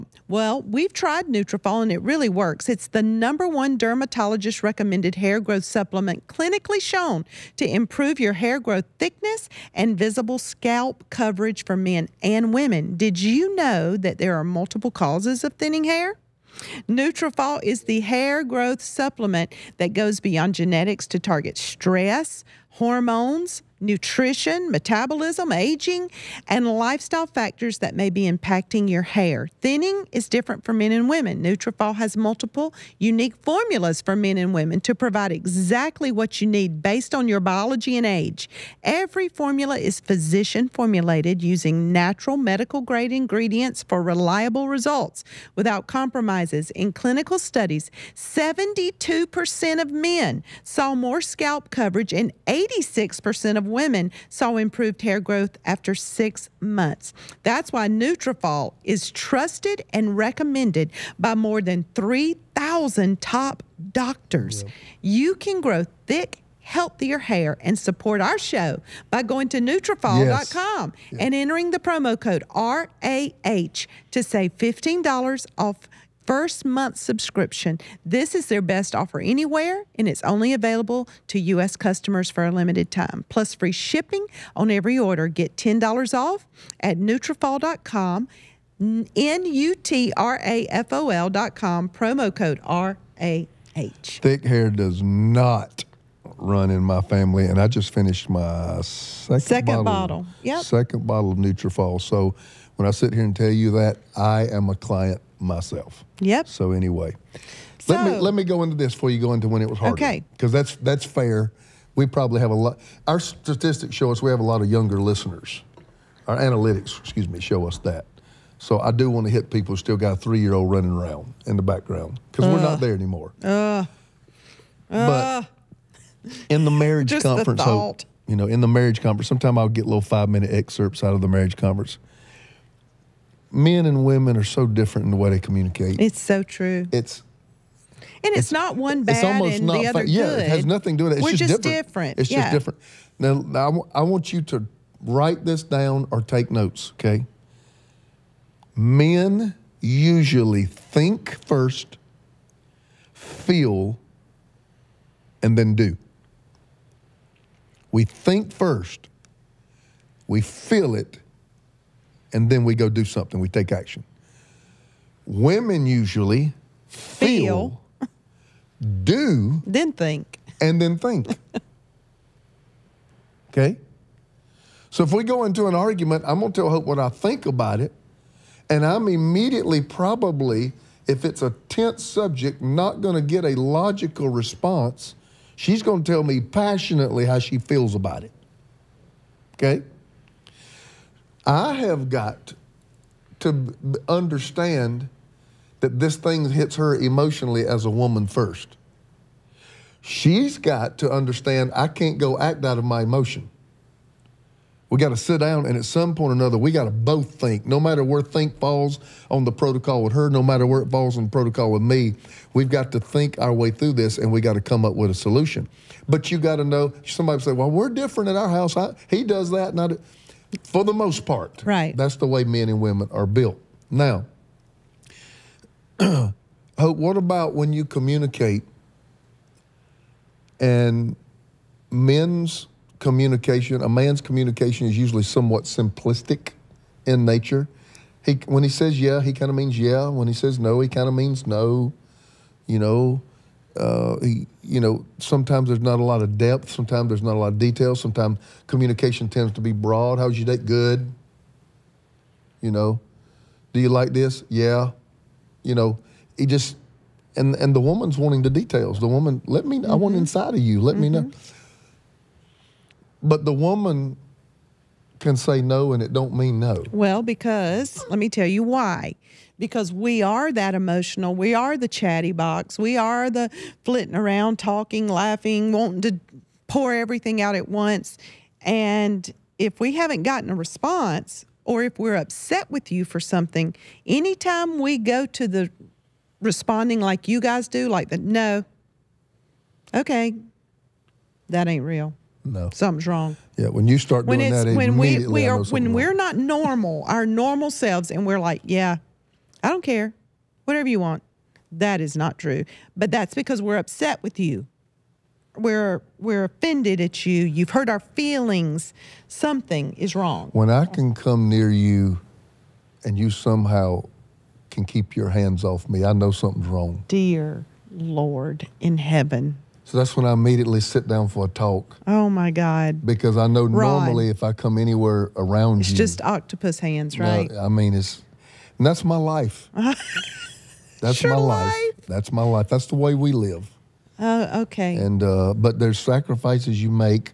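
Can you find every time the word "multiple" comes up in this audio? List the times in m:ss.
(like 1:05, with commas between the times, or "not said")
0:14, 0:32.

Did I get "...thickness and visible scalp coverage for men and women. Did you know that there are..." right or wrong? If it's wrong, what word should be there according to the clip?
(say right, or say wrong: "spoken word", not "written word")
right.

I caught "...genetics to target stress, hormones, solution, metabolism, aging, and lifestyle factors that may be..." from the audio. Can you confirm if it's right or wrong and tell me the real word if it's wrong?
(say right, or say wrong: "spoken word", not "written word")
wrong: "nutrition", not "solution".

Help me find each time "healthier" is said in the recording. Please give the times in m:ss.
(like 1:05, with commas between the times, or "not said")
1:06.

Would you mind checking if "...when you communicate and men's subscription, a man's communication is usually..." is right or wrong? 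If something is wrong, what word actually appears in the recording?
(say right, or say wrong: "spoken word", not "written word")
wrong: "communication", not "subscription".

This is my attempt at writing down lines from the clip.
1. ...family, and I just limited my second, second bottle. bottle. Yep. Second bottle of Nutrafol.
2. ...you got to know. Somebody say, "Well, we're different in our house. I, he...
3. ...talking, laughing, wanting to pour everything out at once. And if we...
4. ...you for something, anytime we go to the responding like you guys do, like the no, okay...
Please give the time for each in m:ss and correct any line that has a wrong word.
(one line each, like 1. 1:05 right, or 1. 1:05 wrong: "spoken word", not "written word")
1. 1:37 wrong: "finished", not "limited"
2. 3:36 right
3. 4:34 right
4. 4:42 right.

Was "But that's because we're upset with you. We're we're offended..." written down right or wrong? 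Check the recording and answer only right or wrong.
right.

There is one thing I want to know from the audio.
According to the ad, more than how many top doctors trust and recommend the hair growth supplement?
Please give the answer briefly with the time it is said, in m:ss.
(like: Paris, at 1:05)
3,000, at 1:01.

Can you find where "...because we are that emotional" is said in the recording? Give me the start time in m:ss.
4:29.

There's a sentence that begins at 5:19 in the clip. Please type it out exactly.
So that's when I immediately sit down for a talk.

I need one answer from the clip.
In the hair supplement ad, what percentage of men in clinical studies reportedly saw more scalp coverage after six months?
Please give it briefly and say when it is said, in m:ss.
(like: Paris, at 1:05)
72%, at 0:48.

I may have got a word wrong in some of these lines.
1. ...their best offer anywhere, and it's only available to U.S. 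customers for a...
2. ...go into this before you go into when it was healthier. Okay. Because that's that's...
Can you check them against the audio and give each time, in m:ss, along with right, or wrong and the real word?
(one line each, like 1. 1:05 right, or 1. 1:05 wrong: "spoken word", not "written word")
1. 1:18 right
2. 1:48 wrong: "harder", not "healthier".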